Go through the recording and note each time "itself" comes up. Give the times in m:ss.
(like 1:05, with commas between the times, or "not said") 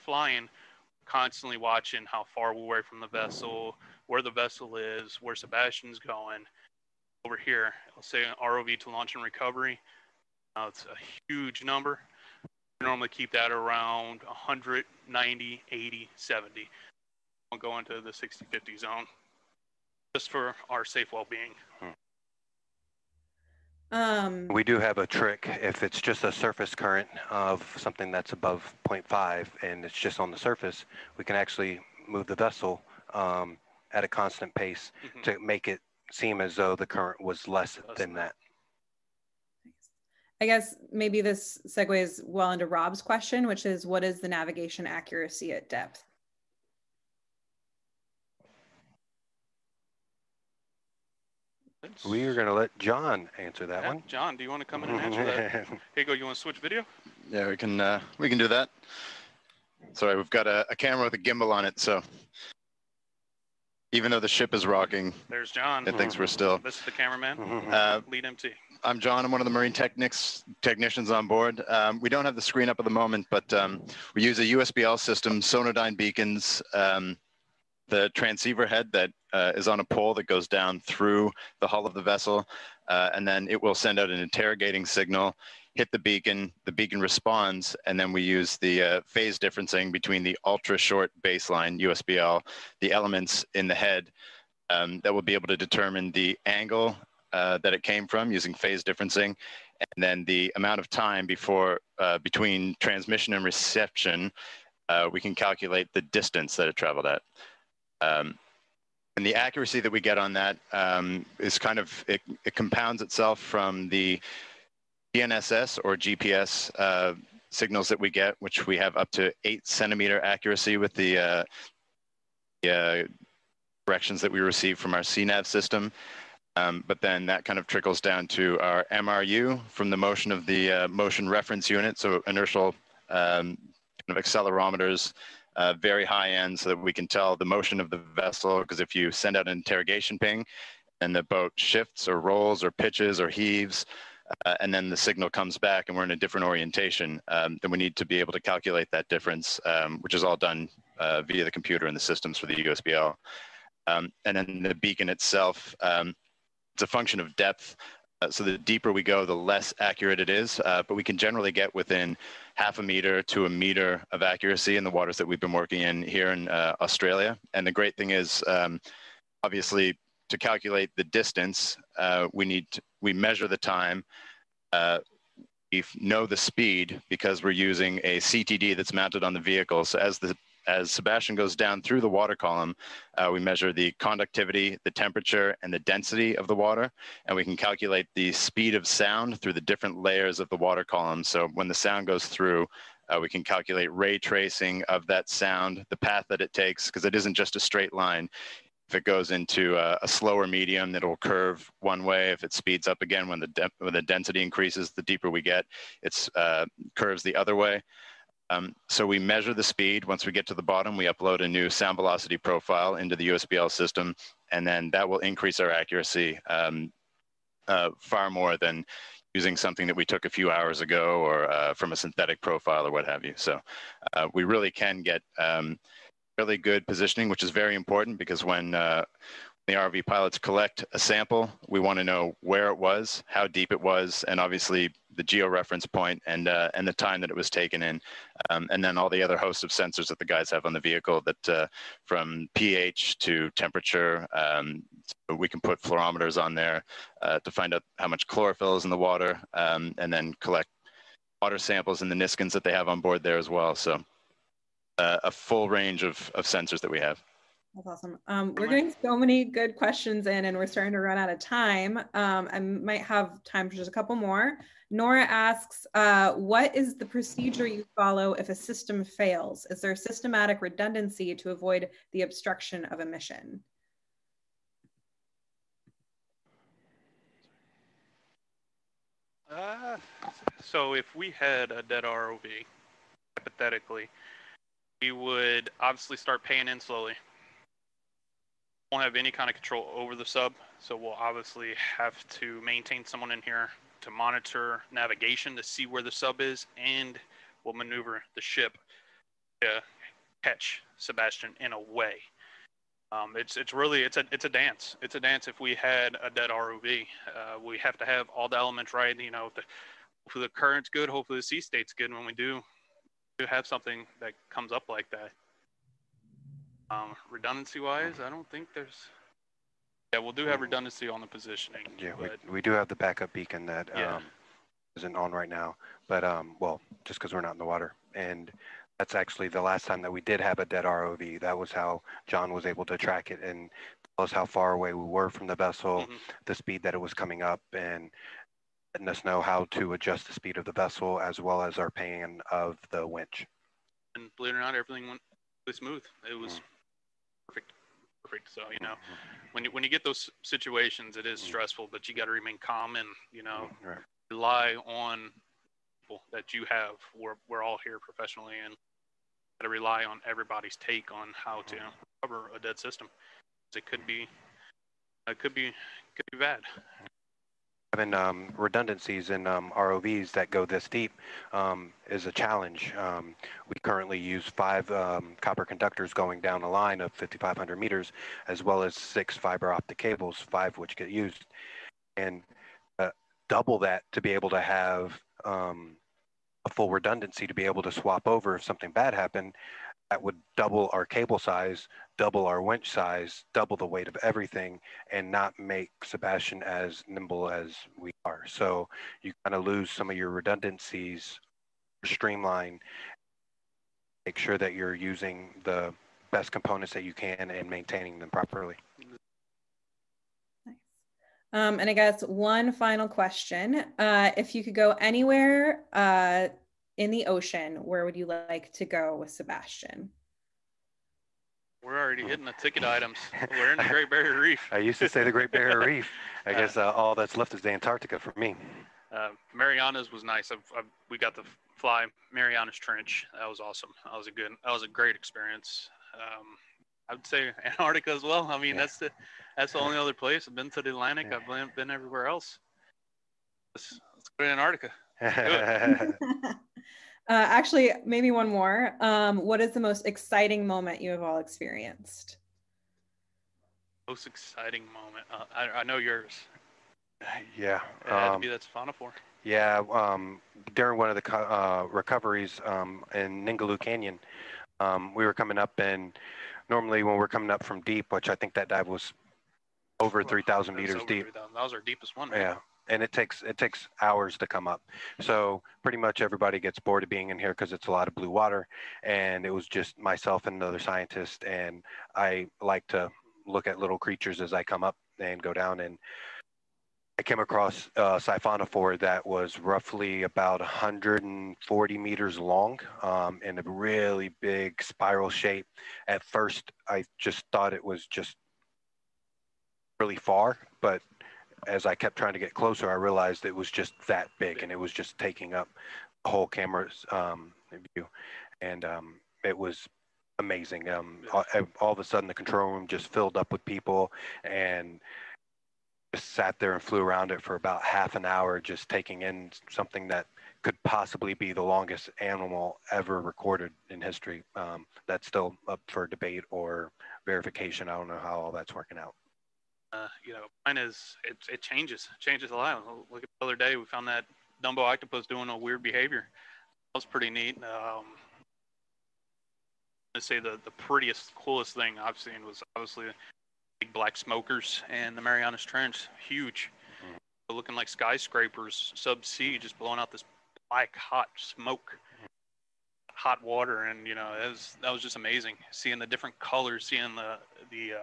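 1:53, 2:35.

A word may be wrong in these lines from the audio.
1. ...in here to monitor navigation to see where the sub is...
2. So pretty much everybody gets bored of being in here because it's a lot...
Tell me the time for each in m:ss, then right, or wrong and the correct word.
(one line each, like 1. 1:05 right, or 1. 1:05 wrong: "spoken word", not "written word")
1. 4:53 right
2. 7:55 right.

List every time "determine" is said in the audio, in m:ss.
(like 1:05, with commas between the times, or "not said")
1:35.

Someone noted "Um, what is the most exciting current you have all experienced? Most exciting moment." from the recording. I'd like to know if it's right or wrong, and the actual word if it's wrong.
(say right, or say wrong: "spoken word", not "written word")
wrong: "moment", not "current".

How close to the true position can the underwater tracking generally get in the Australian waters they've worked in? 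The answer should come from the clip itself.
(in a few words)
half a meter to a meter.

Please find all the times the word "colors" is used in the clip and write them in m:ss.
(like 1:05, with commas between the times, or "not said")
9:16.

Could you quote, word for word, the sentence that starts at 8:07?
I came across a siphonophore that was roughly about 140 meters long um, in a really big spiral shape.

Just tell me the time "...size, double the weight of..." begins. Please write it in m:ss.
6:32.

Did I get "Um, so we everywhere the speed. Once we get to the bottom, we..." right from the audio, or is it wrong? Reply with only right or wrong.
wrong.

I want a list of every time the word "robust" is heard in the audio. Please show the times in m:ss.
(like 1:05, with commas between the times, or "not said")
not said.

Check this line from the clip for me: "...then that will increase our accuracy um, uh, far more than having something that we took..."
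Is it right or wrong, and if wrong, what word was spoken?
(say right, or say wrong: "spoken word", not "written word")
wrong: "using", not "having".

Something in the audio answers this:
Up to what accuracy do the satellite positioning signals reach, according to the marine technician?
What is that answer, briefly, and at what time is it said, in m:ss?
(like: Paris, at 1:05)
8 centimeters, at 1:59.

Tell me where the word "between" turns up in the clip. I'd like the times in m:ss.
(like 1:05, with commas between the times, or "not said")
1:29, 1:42.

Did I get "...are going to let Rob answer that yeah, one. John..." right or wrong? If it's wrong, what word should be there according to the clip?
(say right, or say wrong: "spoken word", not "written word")
wrong: "John", not "Rob".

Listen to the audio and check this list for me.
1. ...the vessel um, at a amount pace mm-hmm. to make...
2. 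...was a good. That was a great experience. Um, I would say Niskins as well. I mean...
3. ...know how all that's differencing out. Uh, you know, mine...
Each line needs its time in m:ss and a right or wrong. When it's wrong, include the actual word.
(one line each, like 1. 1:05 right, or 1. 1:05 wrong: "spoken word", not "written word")
1. 0:32 wrong: "constant", not "amount"
2. 7:14 wrong: "Antarctica", not "Niskins"
3. 8:48 wrong: "working", not "differencing".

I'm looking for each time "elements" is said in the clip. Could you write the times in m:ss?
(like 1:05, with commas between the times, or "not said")
1:32, 5:08.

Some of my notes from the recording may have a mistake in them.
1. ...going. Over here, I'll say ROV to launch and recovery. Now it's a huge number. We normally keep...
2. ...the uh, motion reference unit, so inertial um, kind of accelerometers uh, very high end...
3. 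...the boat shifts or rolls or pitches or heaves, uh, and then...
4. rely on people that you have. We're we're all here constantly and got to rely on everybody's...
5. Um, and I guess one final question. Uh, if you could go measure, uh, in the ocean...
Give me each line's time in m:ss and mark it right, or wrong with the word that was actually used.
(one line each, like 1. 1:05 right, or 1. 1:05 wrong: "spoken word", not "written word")
1. 0:05 right
2. 2:10 right
3. 2:21 right
4. 5:54 wrong: "professionally", not "constantly"
5. 6:51 wrong: "anywhere", not "measure".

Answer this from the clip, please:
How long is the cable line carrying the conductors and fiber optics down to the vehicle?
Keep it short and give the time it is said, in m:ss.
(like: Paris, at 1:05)
5,500 meters, at 6:17.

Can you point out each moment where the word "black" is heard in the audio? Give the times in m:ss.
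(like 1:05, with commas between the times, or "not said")
9:03, 9:10.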